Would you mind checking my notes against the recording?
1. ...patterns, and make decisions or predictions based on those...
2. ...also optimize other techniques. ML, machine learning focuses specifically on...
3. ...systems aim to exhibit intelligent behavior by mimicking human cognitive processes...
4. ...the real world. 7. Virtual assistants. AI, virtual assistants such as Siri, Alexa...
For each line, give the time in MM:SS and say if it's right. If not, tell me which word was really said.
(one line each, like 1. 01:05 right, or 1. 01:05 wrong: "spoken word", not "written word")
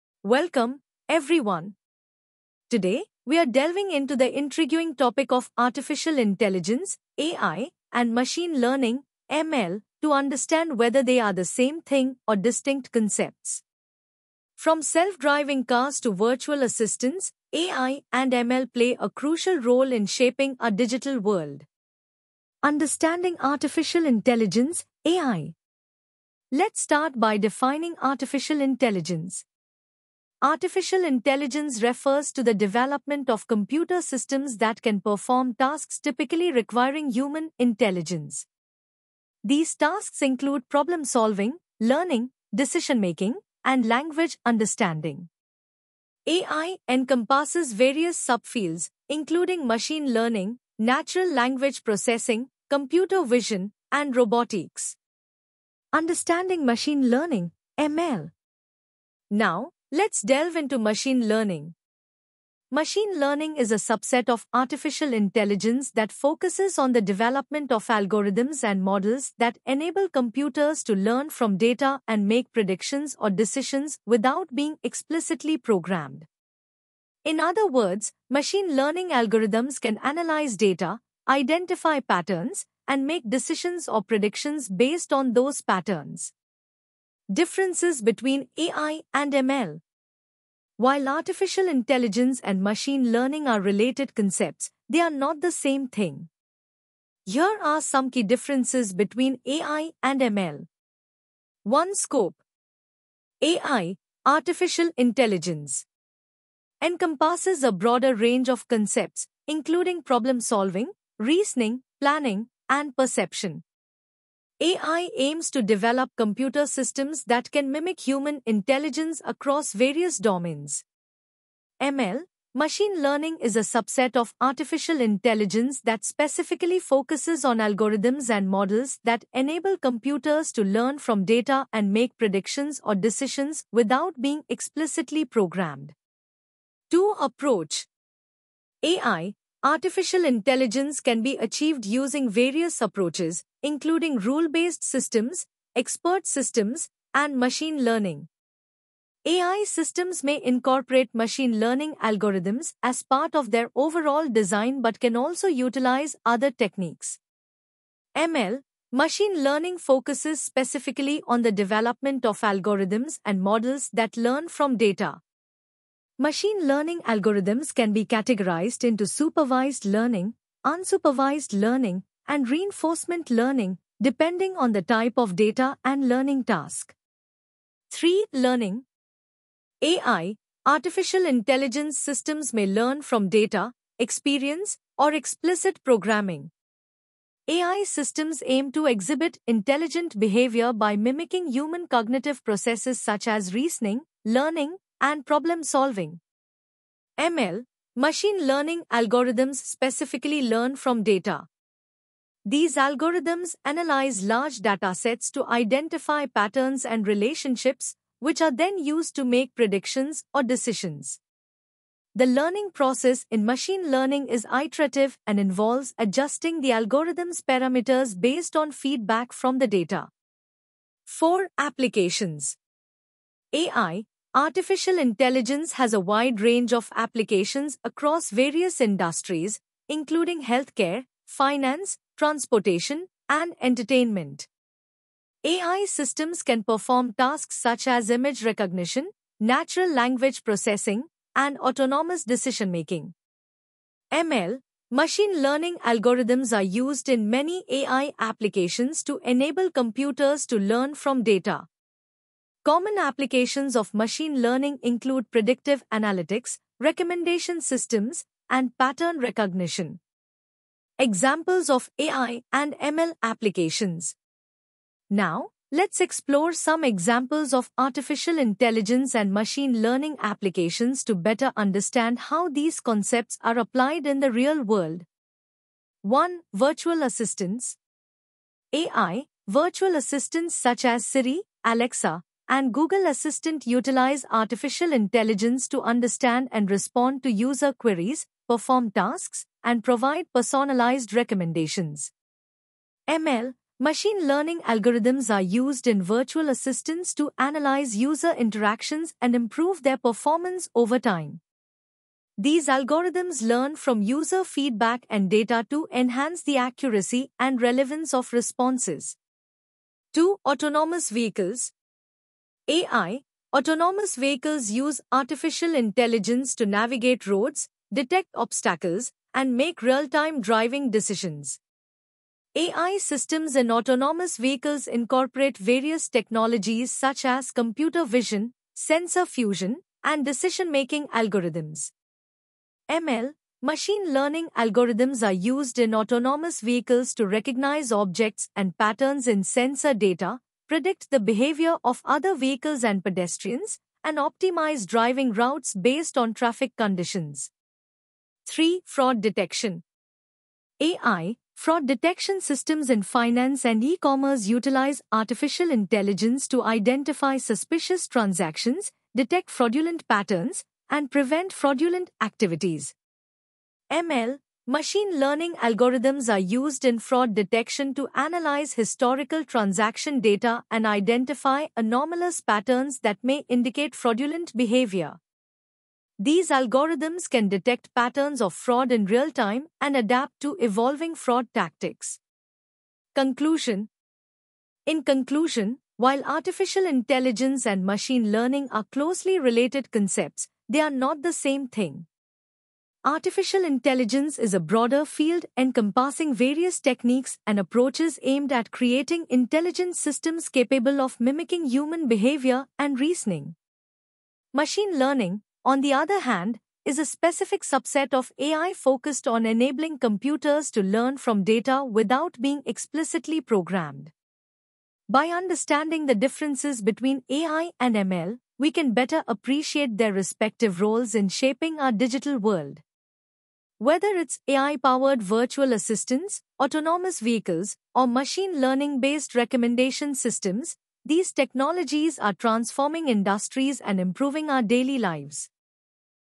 1. 01:21 right
2. 02:35 wrong: "utilize", not "optimize"
3. 03:07 right
4. 04:34 wrong: "1", not "7".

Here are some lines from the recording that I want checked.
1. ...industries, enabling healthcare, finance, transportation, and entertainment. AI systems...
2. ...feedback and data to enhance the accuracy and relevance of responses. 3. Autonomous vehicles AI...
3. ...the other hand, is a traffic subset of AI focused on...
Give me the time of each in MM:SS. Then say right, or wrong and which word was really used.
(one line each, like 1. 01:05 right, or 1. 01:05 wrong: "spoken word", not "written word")
1. 03:48 wrong: "including", not "enabling"
2. 05:04 wrong: "2", not "3"
3. 06:45 wrong: "specific", not "traffic".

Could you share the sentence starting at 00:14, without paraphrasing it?
From self driving cars to virtual assistants, AI and ML play a crucial role in shaping our digital world.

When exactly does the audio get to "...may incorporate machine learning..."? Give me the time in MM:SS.
02:30.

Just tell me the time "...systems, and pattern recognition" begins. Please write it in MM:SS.
04:17.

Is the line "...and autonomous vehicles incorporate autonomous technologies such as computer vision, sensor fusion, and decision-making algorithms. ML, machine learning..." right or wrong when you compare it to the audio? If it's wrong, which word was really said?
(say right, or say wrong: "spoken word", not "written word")
wrong: "various", not "autonomous".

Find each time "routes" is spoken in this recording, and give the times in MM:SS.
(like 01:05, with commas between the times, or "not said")
05:45.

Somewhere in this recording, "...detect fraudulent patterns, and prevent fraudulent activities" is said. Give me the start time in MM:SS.
05:59.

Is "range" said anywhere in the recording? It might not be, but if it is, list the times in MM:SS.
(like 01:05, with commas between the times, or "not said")
01:48, 03:46.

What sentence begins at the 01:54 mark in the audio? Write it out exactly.
AI aims to develop computer systems that can mimic human intelligence across various domains.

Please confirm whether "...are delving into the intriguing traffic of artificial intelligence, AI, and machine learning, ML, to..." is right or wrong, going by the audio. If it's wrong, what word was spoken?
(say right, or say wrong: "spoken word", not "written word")
wrong: "topic", not "traffic".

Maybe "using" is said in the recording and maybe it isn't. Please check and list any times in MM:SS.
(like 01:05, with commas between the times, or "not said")
02:21.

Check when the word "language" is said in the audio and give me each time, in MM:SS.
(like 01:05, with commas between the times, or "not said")
00:43, 00:51, 03:59.